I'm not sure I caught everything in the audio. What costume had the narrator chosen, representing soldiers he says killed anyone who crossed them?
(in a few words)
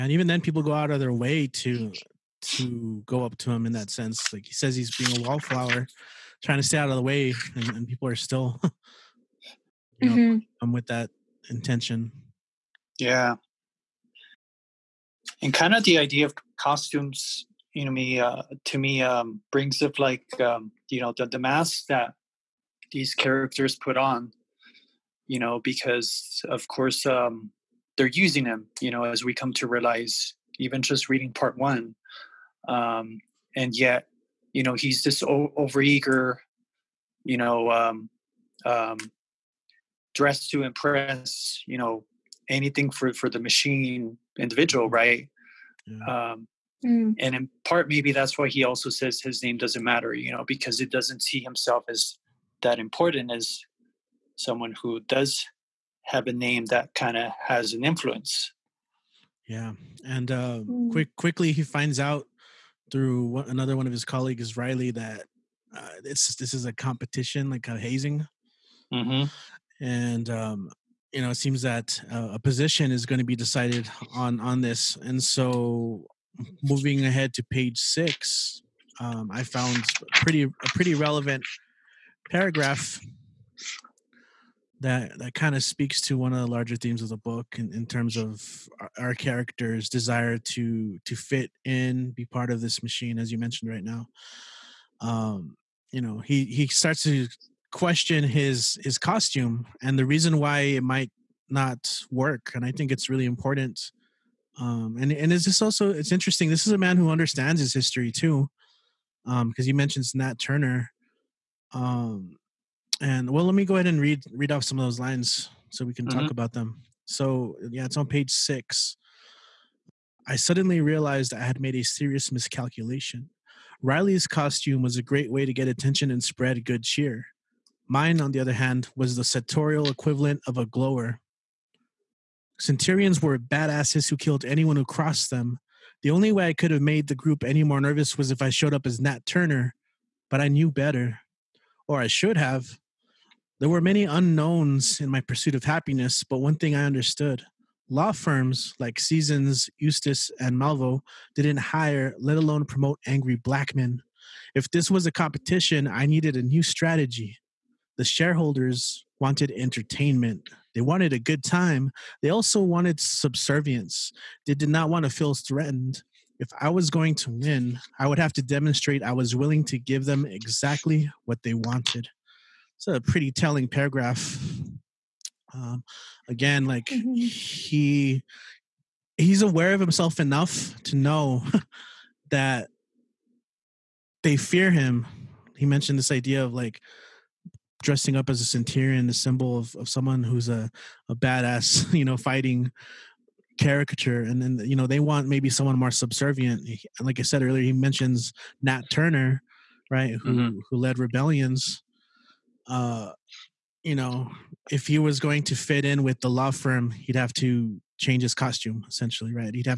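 Centurion.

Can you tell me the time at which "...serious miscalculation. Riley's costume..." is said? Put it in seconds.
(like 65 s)
121 s.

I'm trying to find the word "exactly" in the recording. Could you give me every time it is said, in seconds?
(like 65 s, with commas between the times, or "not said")
170 s.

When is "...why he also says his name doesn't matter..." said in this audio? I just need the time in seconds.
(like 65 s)
48 s.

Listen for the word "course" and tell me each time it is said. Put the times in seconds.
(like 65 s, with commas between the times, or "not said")
26 s.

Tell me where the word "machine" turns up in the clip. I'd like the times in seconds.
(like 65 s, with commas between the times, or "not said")
43 s, 92 s.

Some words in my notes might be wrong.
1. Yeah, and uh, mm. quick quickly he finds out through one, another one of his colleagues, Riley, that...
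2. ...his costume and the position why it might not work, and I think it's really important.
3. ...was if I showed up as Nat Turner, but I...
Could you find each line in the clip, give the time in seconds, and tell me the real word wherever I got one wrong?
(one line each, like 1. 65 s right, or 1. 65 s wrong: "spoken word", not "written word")
1. 59 s right
2. 98 s wrong: "reason", not "position"
3. 138 s right.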